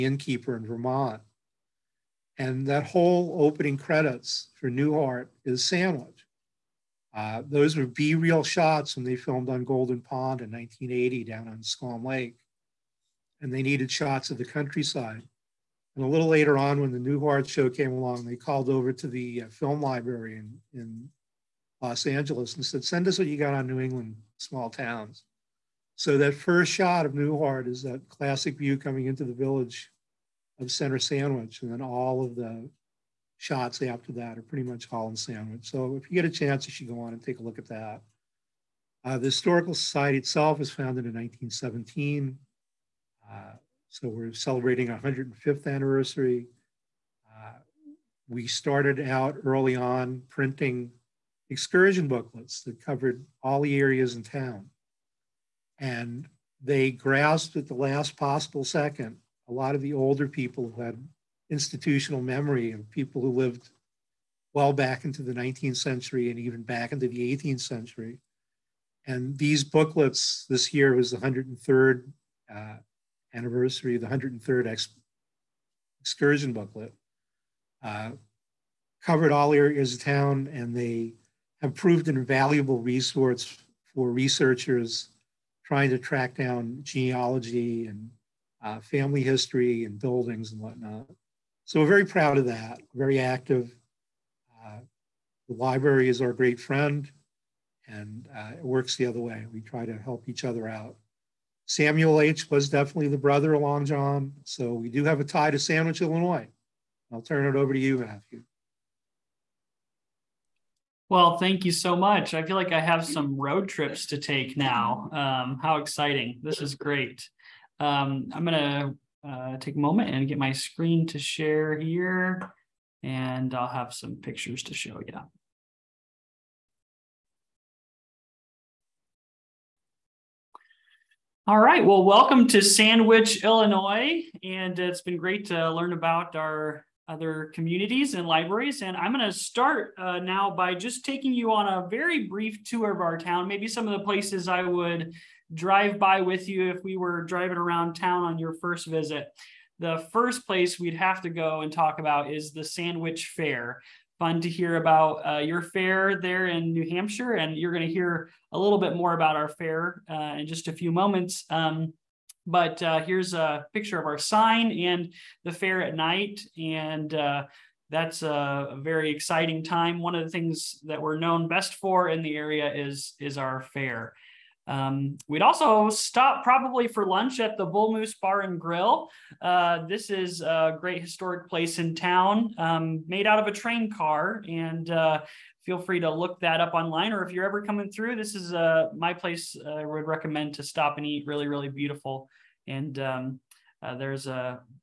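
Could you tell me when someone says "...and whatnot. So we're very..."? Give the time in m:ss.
1:30.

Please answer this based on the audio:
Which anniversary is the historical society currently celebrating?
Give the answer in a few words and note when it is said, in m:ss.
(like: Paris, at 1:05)
105th, at 0:44.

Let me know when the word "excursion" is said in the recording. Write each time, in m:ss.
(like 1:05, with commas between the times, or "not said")
0:51, 1:15.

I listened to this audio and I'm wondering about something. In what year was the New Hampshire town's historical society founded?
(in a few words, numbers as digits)
1917.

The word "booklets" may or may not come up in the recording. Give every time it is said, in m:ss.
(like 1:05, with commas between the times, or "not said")
0:52, 1:09, 1:16.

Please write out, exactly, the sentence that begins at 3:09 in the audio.
Uh, I would recommend to stop and eat.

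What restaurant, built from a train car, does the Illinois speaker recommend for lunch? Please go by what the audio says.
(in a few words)
Bull Moose Bar and Grill.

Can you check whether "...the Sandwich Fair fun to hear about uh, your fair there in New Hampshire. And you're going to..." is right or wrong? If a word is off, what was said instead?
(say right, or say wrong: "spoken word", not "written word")
right.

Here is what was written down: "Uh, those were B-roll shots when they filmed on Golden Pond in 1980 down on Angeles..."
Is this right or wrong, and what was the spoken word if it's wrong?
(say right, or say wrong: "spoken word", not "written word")
wrong: "Squam", not "Angeles".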